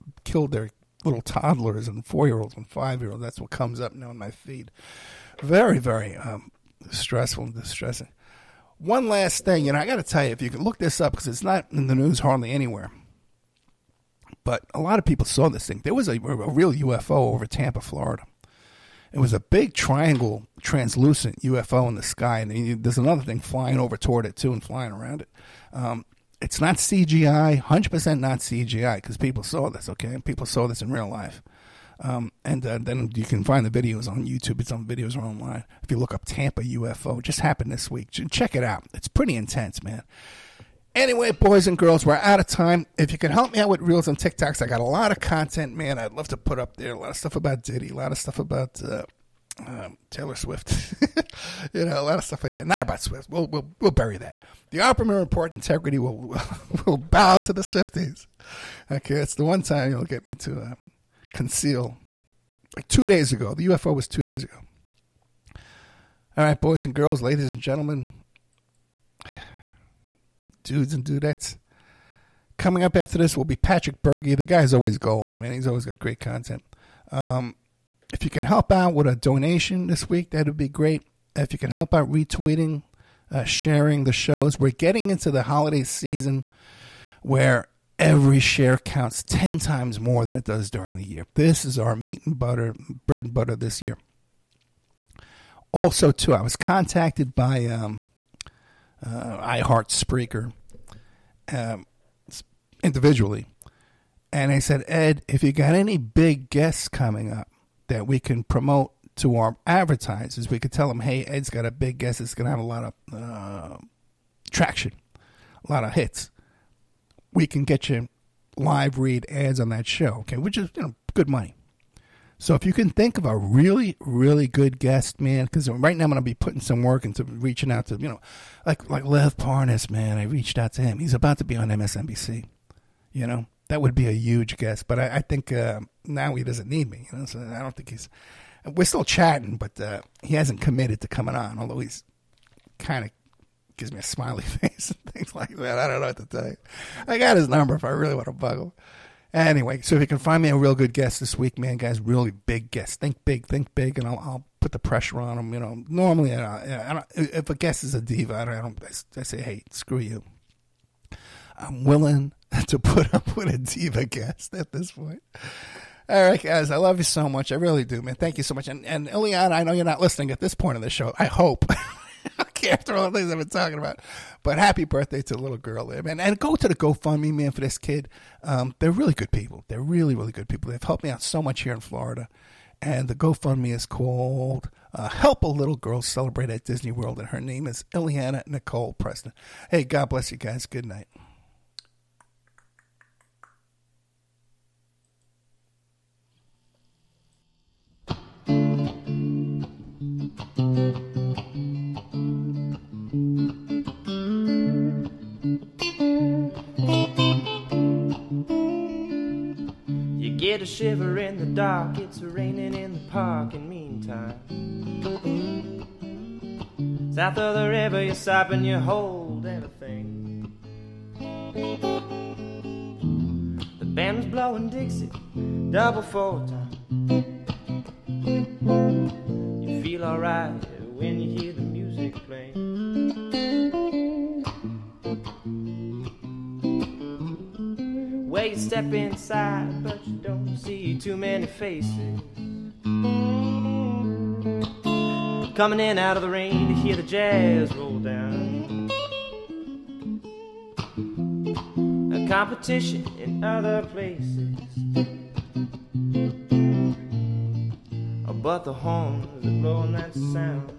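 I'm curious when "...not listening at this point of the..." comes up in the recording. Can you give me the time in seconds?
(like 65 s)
169 s.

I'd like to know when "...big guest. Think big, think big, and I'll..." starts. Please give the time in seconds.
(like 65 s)
152 s.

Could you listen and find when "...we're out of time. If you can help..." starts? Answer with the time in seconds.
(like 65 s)
42 s.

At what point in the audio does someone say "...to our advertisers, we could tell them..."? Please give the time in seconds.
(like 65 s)
109 s.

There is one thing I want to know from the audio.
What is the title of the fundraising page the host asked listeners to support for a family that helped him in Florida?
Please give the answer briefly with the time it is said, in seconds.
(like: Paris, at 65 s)
Help a Little Girl Celebrate at Disney World, at 185 s.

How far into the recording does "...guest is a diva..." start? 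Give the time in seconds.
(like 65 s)
157 s.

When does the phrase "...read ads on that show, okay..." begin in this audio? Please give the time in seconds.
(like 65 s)
118 s.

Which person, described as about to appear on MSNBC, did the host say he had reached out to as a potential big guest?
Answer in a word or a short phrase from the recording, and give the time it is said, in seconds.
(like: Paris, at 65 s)
Lev Parnas, at 129 s.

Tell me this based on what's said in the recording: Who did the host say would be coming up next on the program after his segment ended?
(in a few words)
Patrick Bergy.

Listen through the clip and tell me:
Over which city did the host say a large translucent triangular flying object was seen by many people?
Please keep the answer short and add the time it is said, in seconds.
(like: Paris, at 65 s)
Tampa, Florida, at 17 s.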